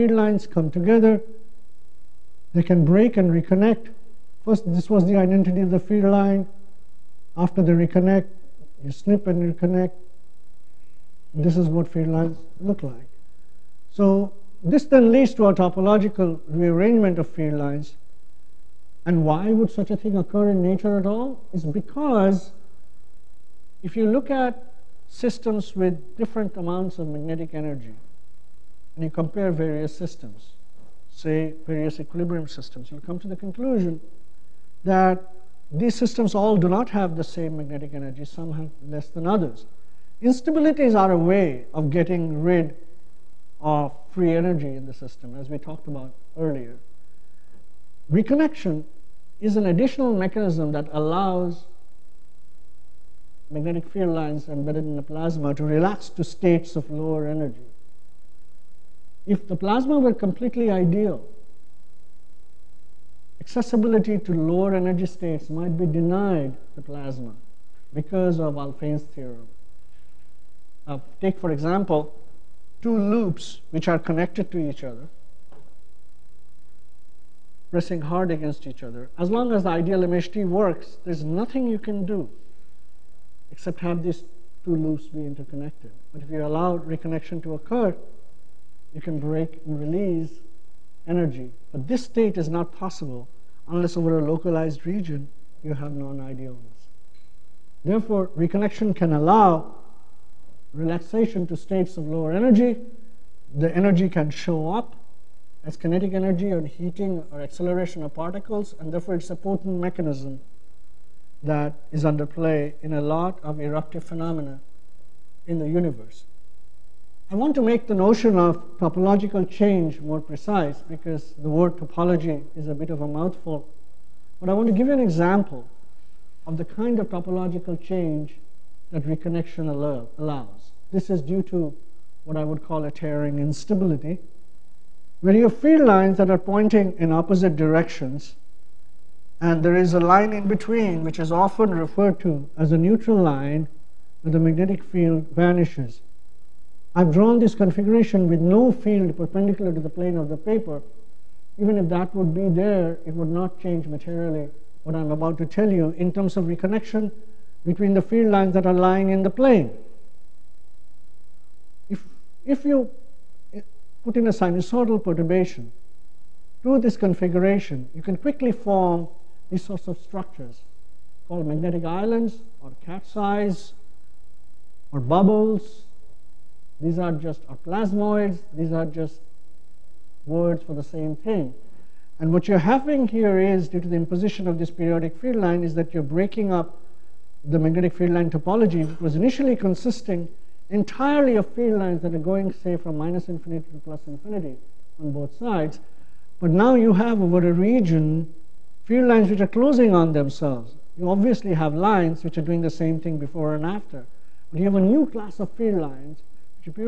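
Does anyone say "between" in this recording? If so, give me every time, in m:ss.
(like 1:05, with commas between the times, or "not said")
2:20, 2:37.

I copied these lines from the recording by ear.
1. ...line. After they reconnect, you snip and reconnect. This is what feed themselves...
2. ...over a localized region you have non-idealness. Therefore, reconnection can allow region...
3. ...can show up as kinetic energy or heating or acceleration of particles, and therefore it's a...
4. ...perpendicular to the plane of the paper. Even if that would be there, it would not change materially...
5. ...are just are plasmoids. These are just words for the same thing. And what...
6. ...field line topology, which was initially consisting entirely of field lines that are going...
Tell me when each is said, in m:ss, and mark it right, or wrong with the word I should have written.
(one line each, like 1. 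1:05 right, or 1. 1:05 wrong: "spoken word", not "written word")
1. 0:06 wrong: "lines", not "themselves"
2. 1:33 wrong: "relaxation", not "region"
3. 1:44 right
4. 2:29 right
5. 2:56 right
6. 3:07 right.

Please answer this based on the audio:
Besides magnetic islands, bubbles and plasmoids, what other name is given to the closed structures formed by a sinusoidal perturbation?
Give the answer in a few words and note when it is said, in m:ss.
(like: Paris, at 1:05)
cat's eyes, at 2:52.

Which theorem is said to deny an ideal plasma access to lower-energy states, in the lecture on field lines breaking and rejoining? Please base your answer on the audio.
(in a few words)
Alfven's theorem.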